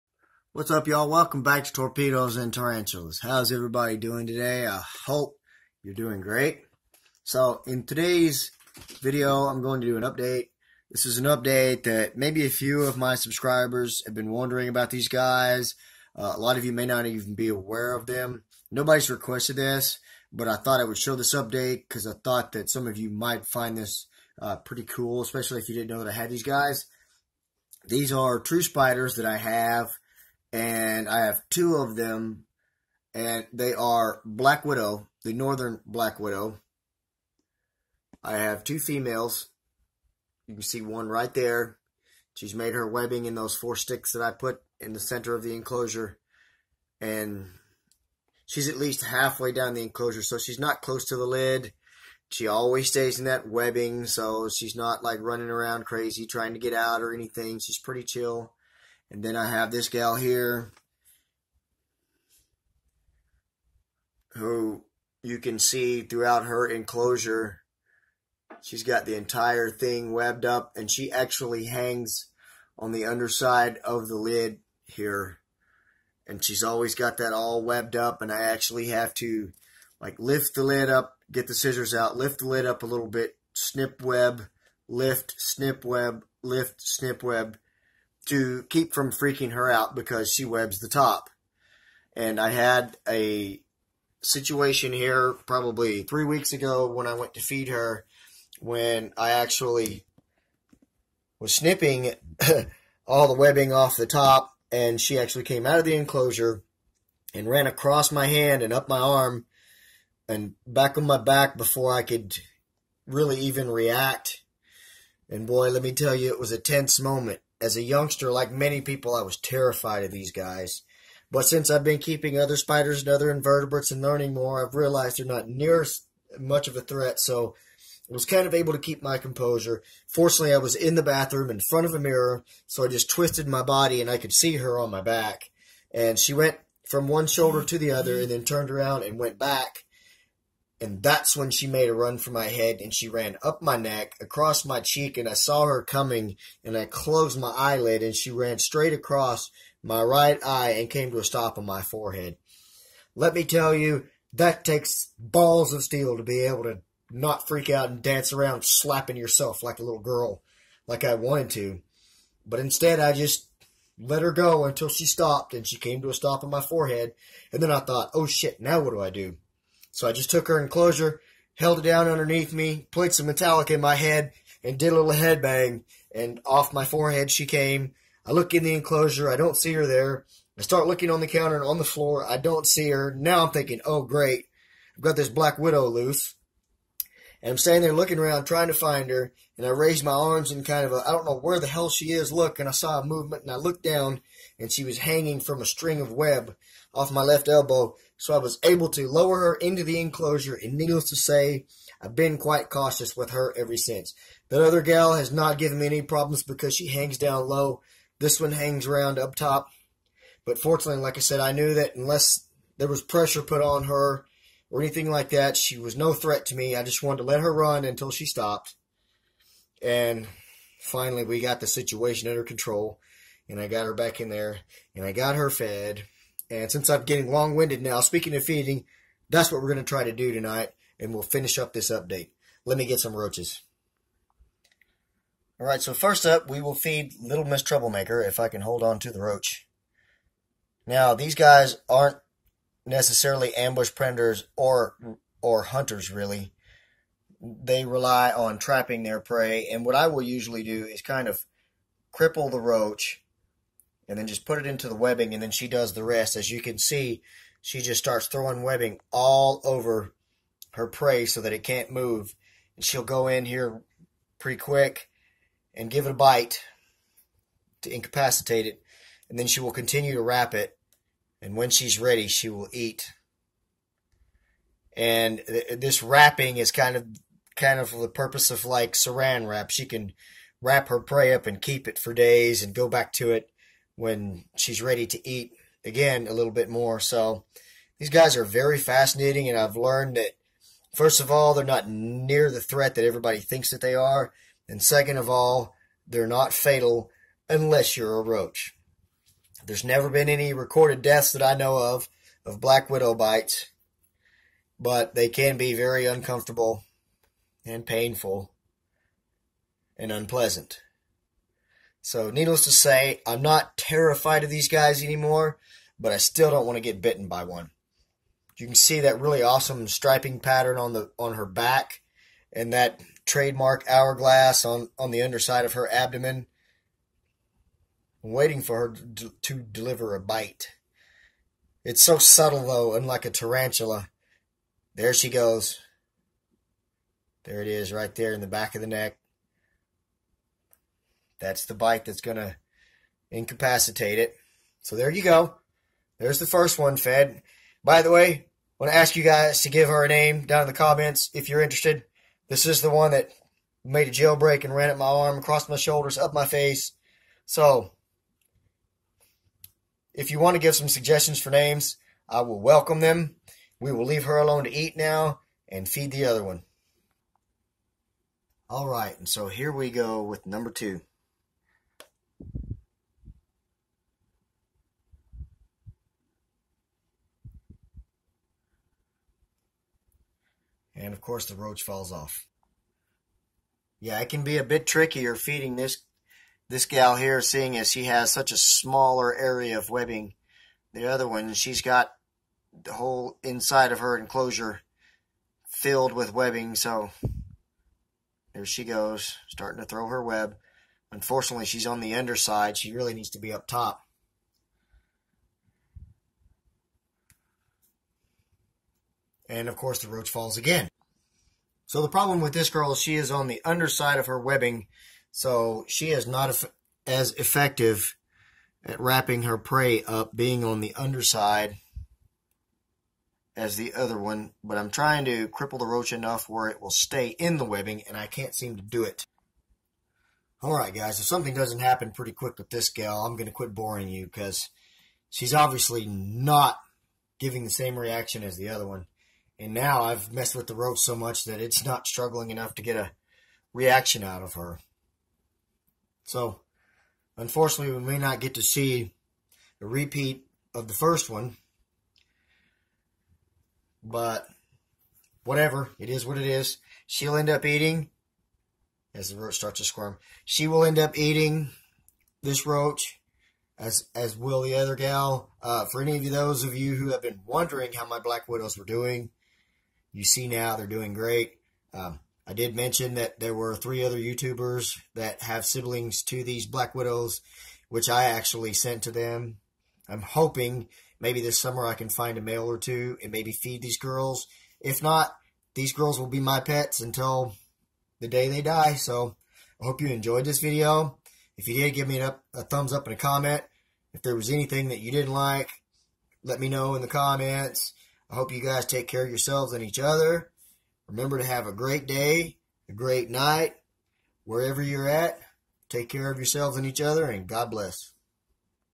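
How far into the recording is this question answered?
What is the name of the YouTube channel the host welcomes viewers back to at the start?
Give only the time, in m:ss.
0:01.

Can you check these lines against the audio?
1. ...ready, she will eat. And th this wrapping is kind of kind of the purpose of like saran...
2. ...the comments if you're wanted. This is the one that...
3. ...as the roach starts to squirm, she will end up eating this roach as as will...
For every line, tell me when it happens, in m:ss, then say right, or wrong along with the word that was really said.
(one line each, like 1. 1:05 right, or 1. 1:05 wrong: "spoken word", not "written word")
1. 4:31 right
2. 5:50 wrong: "interested", not "wanted"
3. 7:39 right.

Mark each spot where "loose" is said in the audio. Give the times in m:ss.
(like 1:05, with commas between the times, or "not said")
3:05.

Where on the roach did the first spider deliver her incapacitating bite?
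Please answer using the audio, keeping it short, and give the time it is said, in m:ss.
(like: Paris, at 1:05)
back of the neck, at 5:38.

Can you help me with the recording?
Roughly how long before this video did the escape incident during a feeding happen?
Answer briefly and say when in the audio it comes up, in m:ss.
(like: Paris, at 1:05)
3 weeks, at 1:36.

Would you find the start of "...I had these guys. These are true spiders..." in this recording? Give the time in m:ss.
0:26.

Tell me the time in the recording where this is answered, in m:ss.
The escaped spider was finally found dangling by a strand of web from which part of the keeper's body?
3:17.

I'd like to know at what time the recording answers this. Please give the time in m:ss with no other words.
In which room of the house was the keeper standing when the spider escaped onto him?
2:11.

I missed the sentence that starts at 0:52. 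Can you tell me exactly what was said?
She always stays in that webbing, so she's not like running around crazy trying to get out or anything.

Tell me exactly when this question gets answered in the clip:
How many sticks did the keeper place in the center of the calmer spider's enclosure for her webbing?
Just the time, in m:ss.
0:43.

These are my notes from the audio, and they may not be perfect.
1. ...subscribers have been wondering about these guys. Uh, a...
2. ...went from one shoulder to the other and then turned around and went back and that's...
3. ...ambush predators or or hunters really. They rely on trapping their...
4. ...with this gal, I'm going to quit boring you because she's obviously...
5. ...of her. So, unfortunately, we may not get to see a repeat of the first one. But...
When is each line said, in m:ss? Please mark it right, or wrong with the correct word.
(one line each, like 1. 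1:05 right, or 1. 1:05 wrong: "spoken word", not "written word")
1. 0:13 right
2. 2:16 right
3. 4:03 right
4. 7:12 right
5. 7:24 right.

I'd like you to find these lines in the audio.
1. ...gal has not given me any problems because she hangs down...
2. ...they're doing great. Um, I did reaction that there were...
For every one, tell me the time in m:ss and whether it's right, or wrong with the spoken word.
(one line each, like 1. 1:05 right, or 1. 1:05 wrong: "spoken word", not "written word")
1. 3:24 right
2. 7:50 wrong: "mention", not "reaction".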